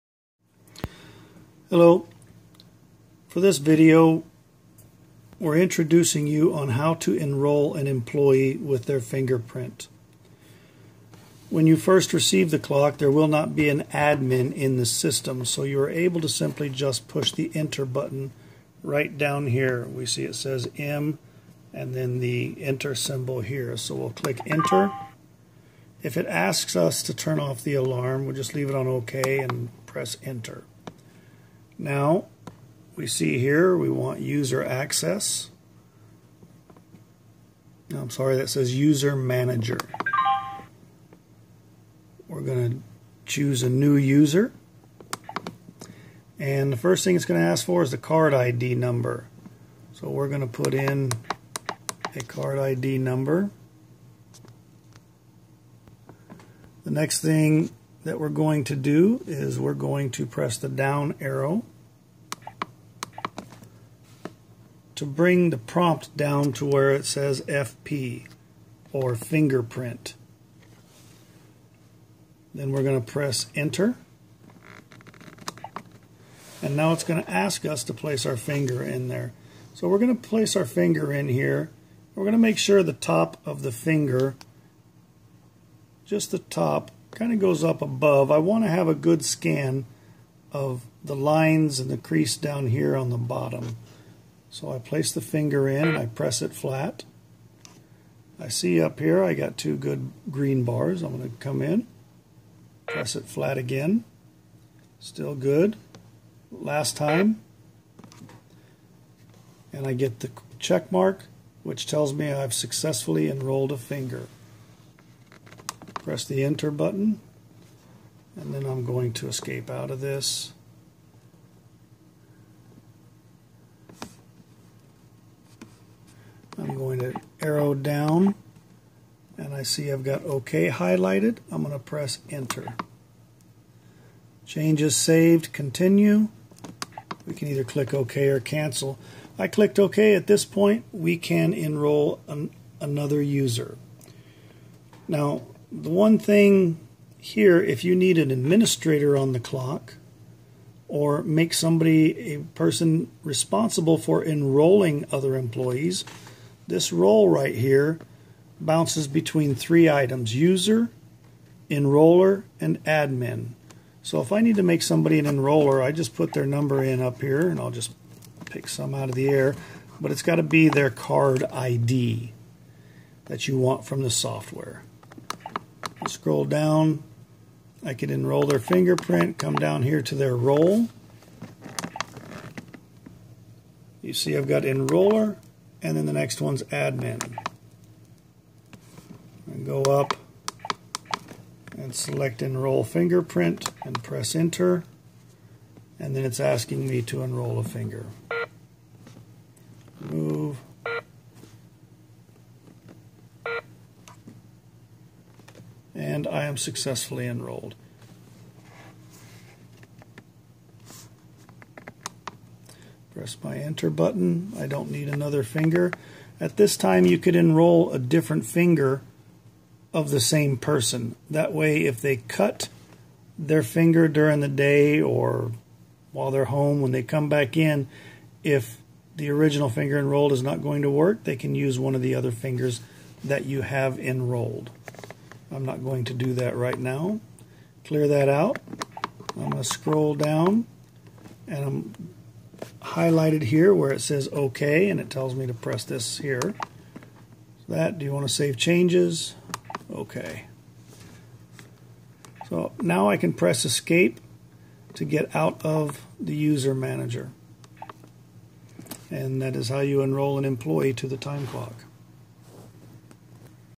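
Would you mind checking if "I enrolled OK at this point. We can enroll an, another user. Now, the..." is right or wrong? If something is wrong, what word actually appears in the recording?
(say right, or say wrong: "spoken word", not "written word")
wrong: "clicked", not "enrolled".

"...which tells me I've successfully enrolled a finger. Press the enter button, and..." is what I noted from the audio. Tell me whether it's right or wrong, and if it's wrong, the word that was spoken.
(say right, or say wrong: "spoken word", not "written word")
right.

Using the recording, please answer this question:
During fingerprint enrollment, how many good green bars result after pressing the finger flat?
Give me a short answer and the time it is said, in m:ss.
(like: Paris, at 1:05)
2, at 1:39.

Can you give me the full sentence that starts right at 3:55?
I'm not going to do that right now.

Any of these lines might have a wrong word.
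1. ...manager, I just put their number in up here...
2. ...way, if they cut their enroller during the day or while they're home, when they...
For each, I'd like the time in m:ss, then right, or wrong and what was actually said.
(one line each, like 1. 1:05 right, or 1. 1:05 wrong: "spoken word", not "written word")
1. 2:45 wrong: "enroller", not "manager"
2. 3:41 wrong: "finger", not "enroller".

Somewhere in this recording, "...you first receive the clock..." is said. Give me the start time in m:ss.
0:11.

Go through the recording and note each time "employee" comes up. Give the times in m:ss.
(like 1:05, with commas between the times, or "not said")
0:07, 2:35, 4:20.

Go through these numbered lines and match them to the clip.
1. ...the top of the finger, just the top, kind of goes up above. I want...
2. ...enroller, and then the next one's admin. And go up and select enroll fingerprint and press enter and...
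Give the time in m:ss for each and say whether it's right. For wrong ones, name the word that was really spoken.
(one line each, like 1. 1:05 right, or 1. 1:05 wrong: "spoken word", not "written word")
1. 1:22 right
2. 3:04 right.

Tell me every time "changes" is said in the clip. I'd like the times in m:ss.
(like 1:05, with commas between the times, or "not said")
2:14, 4:08.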